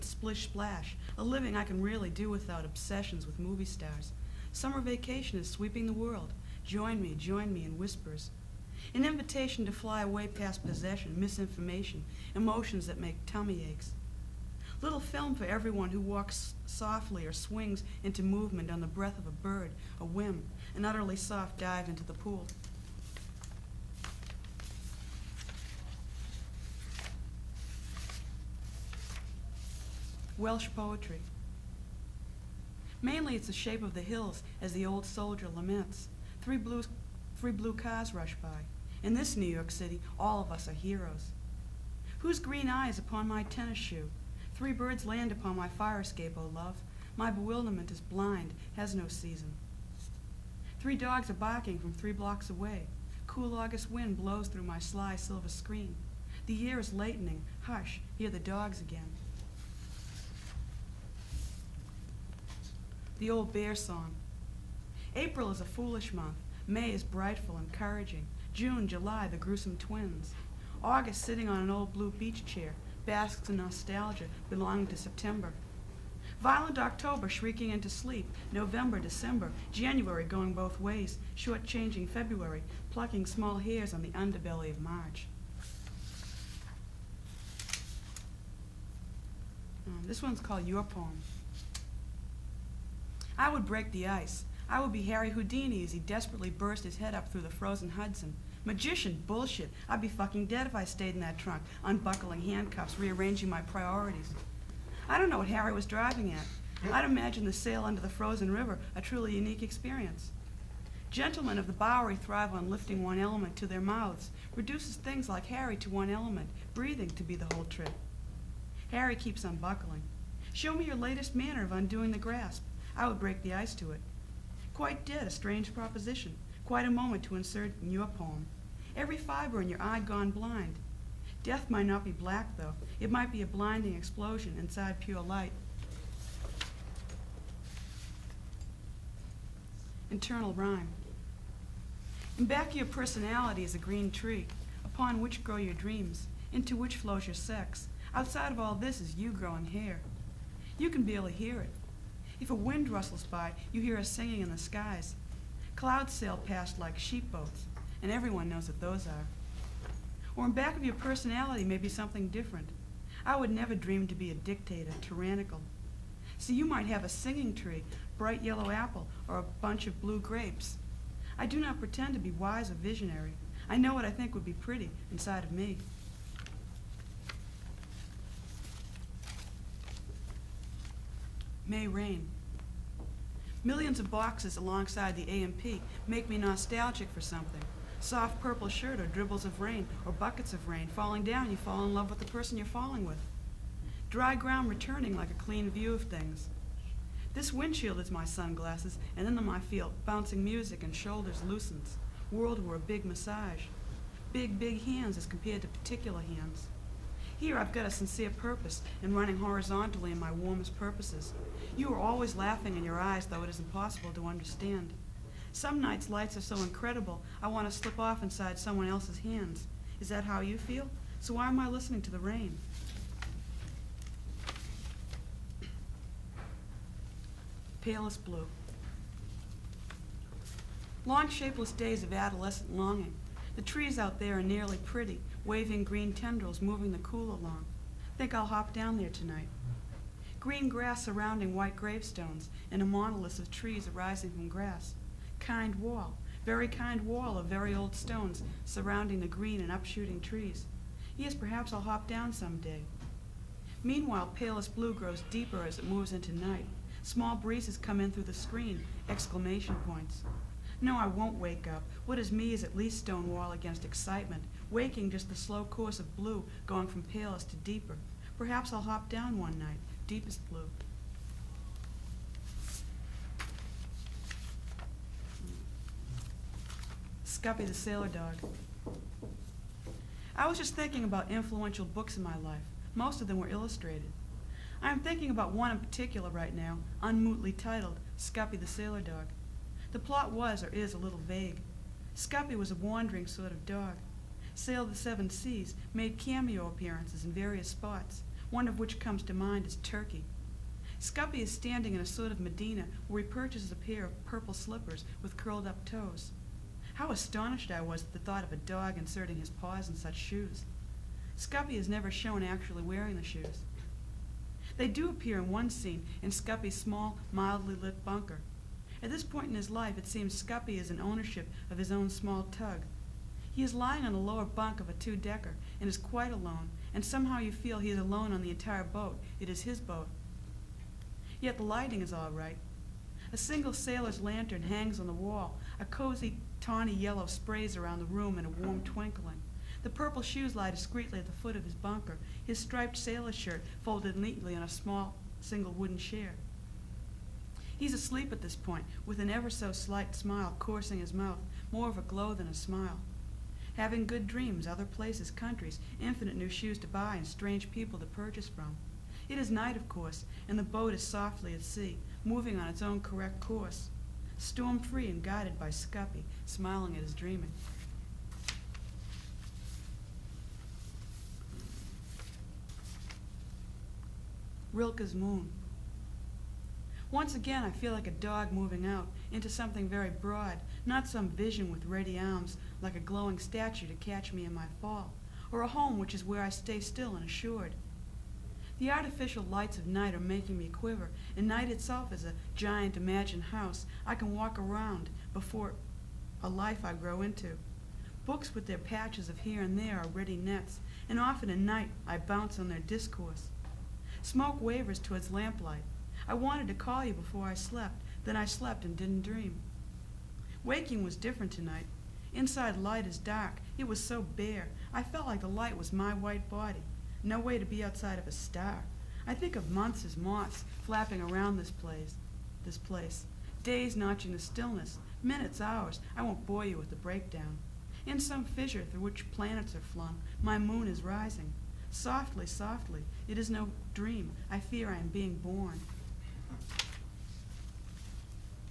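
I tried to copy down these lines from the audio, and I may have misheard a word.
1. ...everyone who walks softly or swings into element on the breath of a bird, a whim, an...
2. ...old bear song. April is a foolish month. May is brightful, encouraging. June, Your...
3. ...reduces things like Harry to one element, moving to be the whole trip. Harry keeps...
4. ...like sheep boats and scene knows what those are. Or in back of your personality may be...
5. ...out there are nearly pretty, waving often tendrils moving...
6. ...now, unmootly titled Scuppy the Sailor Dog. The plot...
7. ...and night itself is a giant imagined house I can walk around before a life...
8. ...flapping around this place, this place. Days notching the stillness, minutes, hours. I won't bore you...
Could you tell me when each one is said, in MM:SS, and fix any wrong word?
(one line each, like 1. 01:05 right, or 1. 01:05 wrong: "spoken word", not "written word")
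1. 00:15 wrong: "movement", not "element"
2. 01:03 wrong: "July", not "Your"
3. 01:54 wrong: "breathing", not "moving"
4. 02:36 wrong: "everyone", not "scene"
5. 03:53 wrong: "green", not "often"
6. 04:46 right
7. 06:31 right
8. 07:00 right.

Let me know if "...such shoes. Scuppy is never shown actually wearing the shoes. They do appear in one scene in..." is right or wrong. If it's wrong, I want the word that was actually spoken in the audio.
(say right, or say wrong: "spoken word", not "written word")
right.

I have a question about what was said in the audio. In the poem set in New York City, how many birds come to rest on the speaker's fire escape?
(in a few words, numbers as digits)
3.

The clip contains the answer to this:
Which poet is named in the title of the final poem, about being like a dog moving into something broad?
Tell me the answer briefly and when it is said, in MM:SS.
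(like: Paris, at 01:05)
Rilke, at 06:14.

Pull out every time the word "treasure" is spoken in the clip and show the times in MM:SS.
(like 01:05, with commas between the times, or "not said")
not said.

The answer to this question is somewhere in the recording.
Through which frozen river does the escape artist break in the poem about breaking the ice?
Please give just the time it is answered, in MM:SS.
01:37.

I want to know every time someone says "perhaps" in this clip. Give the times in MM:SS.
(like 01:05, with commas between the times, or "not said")
04:11, 04:28.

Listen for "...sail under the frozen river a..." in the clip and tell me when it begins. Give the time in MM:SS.
01:47.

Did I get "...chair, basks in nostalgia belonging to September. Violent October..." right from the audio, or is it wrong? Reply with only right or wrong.
right.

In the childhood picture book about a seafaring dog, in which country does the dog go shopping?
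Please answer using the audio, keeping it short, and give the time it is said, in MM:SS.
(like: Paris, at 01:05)
Turkey, at 04:59.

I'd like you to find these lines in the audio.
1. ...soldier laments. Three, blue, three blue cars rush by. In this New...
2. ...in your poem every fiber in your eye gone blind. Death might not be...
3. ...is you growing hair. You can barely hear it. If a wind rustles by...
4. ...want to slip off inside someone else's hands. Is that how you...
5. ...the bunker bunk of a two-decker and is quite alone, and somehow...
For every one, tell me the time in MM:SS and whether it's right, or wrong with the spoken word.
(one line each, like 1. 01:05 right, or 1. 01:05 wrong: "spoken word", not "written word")
1. 00:35 right
2. 02:07 right
3. 02:28 right
4. 03:37 right
5. 05:24 wrong: "lower", not "bunker".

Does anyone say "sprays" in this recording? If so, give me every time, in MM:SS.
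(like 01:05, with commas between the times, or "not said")
05:37.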